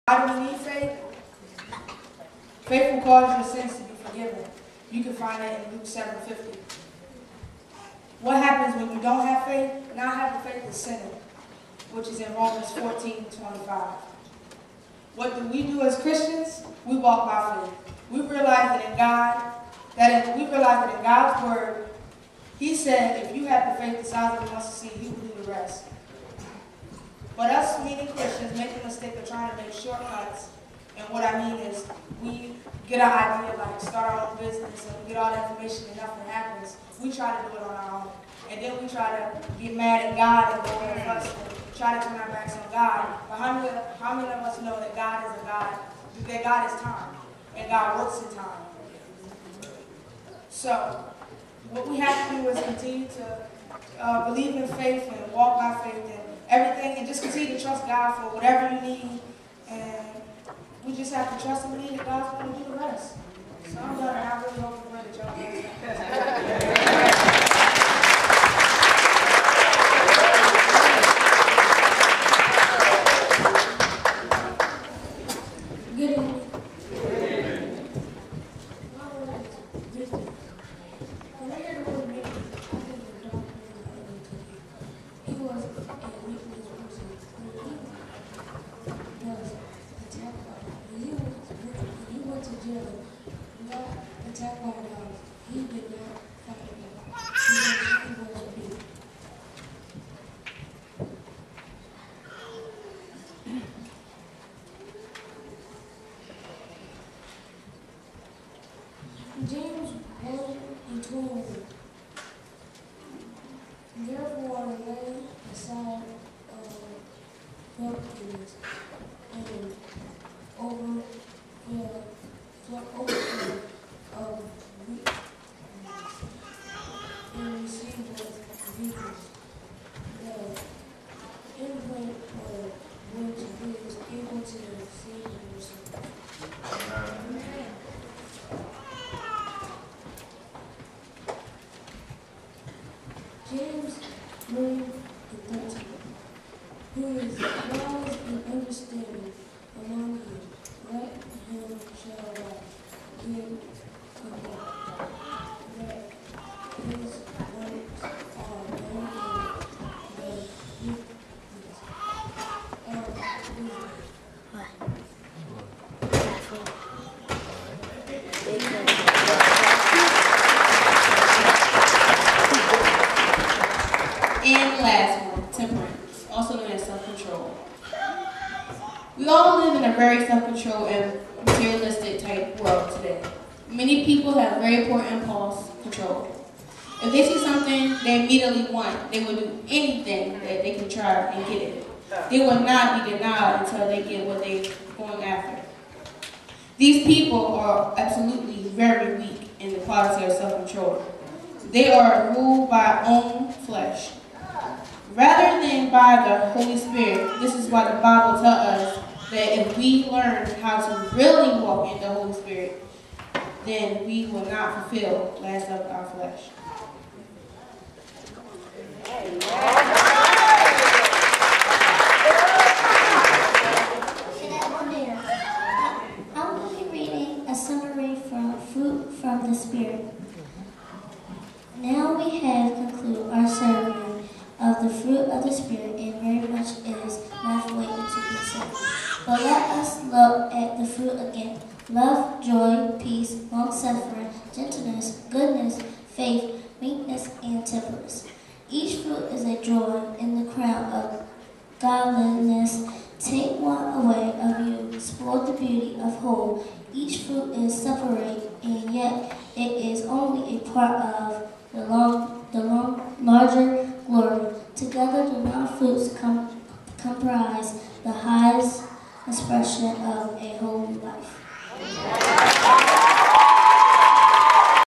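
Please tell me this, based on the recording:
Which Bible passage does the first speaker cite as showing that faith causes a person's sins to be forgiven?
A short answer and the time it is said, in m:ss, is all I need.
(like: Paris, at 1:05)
Luke 7:50, at 0:05.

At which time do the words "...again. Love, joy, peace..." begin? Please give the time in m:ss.
4:01.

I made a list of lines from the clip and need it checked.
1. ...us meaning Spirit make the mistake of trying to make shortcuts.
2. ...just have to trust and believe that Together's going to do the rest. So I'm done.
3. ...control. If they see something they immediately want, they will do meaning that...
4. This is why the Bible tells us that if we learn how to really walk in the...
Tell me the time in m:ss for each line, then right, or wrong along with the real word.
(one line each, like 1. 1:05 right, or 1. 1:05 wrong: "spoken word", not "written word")
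1. 0:27 wrong: "Christians", not "Spirit"
2. 1:00 wrong: "God", not "Together"
3. 3:05 wrong: "anything", not "meaning"
4. 3:27 right.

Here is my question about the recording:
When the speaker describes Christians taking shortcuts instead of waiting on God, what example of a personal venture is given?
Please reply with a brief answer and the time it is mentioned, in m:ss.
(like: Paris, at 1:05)
Start our own business, at 0:33.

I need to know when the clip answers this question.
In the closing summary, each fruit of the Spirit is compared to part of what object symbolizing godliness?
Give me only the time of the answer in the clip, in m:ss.
4:10.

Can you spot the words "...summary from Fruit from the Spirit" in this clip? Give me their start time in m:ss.
3:47.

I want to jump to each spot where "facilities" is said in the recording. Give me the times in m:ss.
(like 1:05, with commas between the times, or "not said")
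not said.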